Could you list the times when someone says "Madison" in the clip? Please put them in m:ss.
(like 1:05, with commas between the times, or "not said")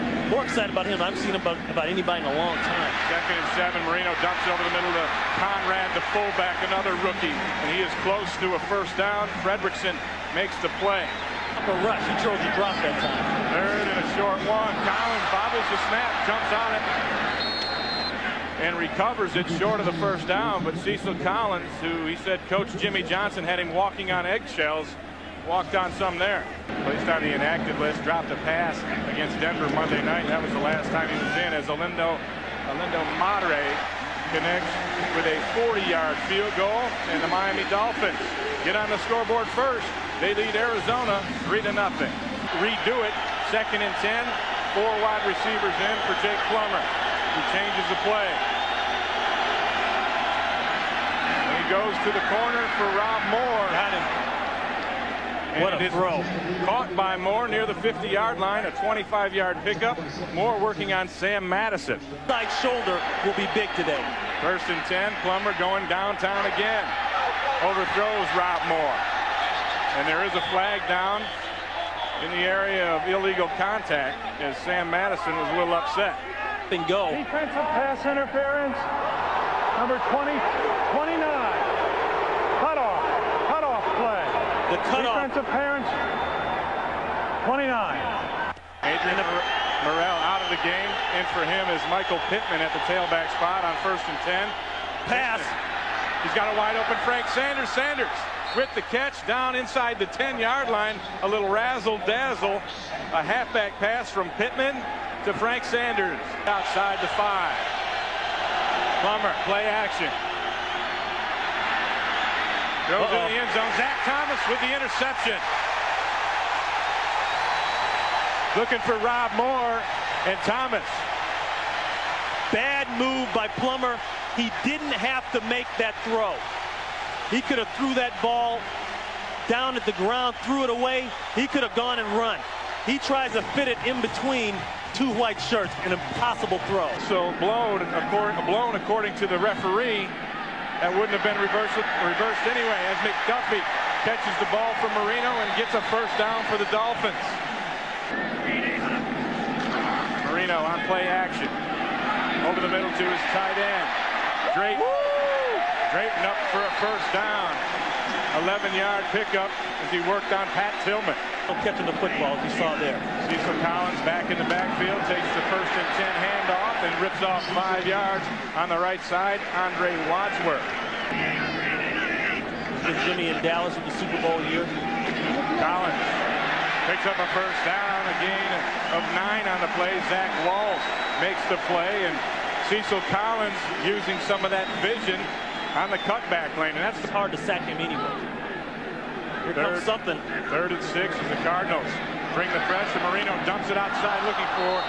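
1:01, 1:14.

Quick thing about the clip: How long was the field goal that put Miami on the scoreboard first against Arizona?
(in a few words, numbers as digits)
40 yards.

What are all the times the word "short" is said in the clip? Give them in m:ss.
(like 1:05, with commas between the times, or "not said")
0:14, 0:19.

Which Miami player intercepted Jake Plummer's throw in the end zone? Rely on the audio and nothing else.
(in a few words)
Zach Thomas.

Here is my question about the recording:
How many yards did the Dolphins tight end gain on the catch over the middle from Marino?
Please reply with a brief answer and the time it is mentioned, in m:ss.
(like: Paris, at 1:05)
11, at 2:38.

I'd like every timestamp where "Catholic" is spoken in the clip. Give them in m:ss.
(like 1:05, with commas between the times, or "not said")
not said.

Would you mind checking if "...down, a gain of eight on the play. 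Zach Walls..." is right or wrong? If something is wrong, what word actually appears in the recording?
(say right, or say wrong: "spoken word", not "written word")
wrong: "nine", not "eight".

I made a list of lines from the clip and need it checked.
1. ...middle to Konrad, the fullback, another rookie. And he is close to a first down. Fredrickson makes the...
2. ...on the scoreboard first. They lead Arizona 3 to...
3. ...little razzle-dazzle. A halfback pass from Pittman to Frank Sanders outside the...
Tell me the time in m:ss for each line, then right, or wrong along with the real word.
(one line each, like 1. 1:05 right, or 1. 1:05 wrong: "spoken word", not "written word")
1. 0:04 right
2. 0:38 right
3. 1:41 right.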